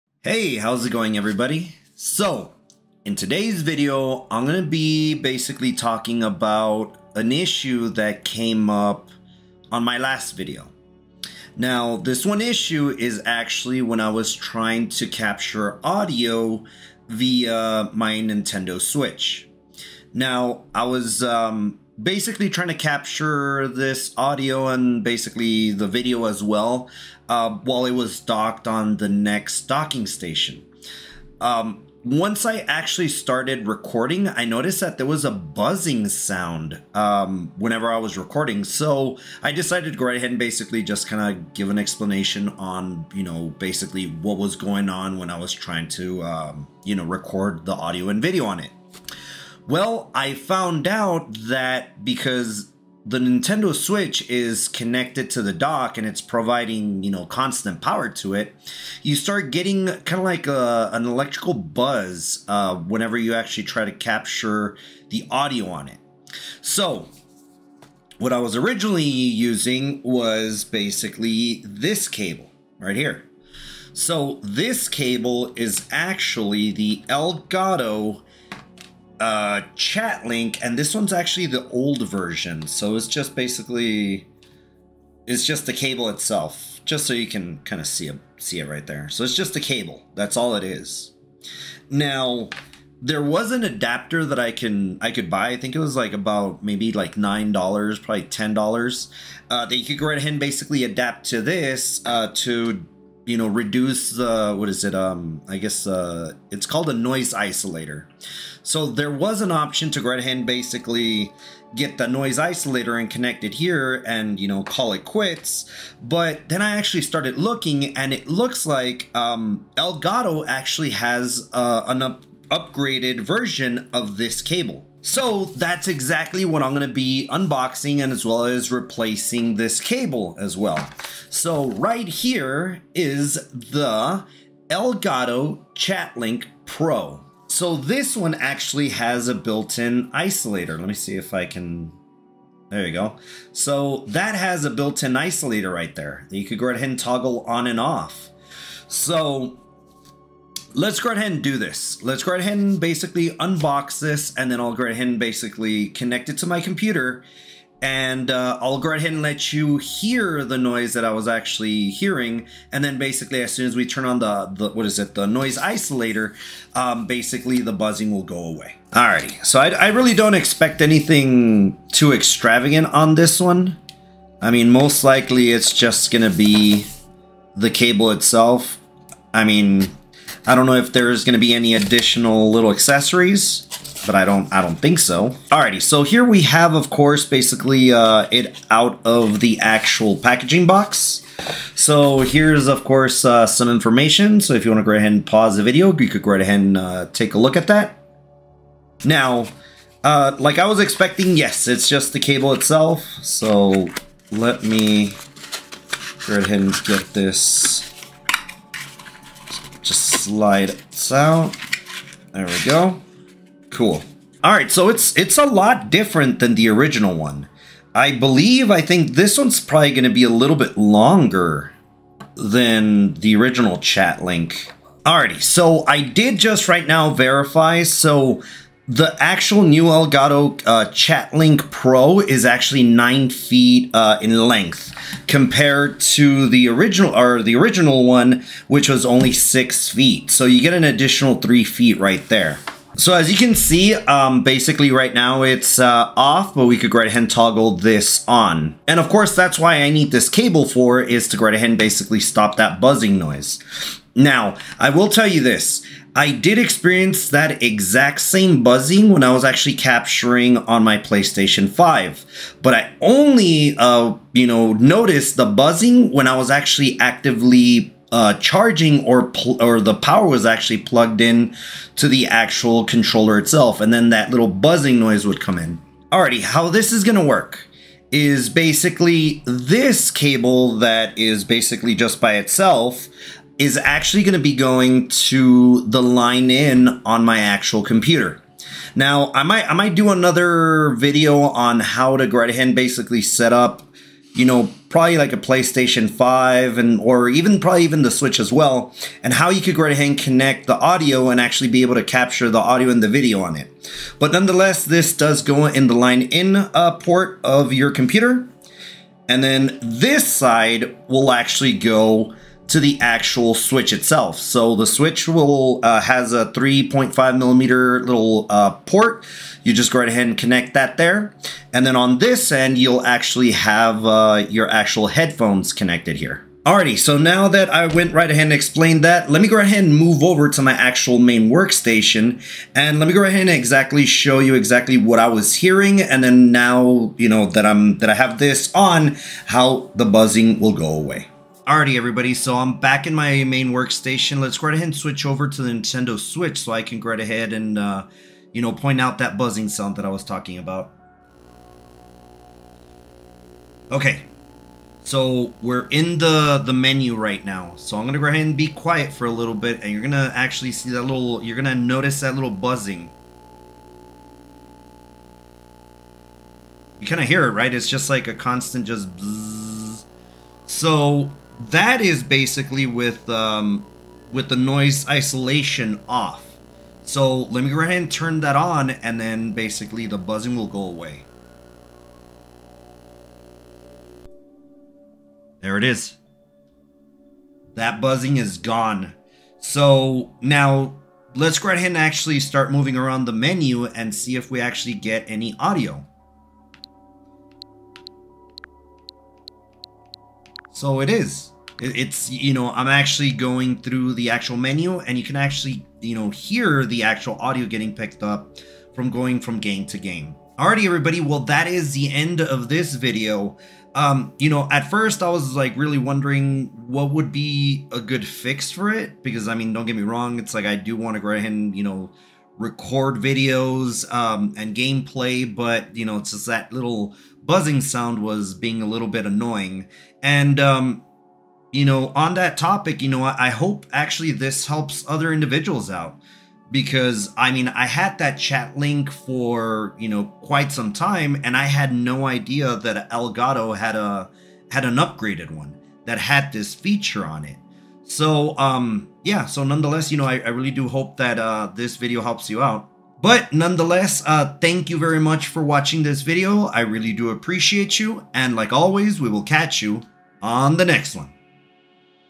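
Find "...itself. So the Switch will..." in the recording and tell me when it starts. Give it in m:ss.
5:13.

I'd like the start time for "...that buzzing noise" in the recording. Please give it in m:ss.
4:12.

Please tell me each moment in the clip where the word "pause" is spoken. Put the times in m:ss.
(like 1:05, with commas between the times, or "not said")
3:15.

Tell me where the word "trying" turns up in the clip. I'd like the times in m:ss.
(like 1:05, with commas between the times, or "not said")
0:14, 0:22, 0:45.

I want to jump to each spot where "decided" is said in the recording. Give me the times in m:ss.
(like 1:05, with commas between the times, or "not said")
0:39.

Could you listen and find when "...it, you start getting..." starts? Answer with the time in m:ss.
0:58.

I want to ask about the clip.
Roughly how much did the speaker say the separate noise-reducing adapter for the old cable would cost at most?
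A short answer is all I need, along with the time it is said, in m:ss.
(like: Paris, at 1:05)
$10, at 1:38.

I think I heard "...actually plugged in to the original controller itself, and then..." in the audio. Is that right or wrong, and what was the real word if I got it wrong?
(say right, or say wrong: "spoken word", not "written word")
wrong: "actual", not "original".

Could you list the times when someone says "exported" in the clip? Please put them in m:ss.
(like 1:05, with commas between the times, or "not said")
not said.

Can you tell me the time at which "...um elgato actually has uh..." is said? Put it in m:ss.
1:59.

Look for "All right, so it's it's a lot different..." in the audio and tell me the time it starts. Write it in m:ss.
3:34.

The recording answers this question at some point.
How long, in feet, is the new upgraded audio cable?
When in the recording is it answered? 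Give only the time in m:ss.
3:52.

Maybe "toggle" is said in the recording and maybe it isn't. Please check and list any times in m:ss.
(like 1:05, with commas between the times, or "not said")
2:26, 4:07.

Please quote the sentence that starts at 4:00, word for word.
So you get an additional three feet right there.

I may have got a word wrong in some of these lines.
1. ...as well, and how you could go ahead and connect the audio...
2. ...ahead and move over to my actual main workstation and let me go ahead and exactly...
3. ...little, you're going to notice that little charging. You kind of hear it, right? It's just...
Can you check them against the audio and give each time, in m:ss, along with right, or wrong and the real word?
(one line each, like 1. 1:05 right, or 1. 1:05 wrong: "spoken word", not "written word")
1. 4:58 right
2. 5:29 right
3. 6:01 wrong: "buzzing", not "charging".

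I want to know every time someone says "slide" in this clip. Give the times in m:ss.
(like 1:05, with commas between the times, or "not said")
3:30.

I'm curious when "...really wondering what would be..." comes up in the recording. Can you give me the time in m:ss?
6:55.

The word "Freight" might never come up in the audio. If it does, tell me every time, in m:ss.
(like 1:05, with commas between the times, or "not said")
not said.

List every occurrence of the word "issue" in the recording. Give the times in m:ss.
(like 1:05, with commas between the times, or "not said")
0:07, 0:12.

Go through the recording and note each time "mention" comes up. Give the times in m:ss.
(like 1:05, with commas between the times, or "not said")
not said.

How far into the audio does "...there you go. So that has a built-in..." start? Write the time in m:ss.
2:22.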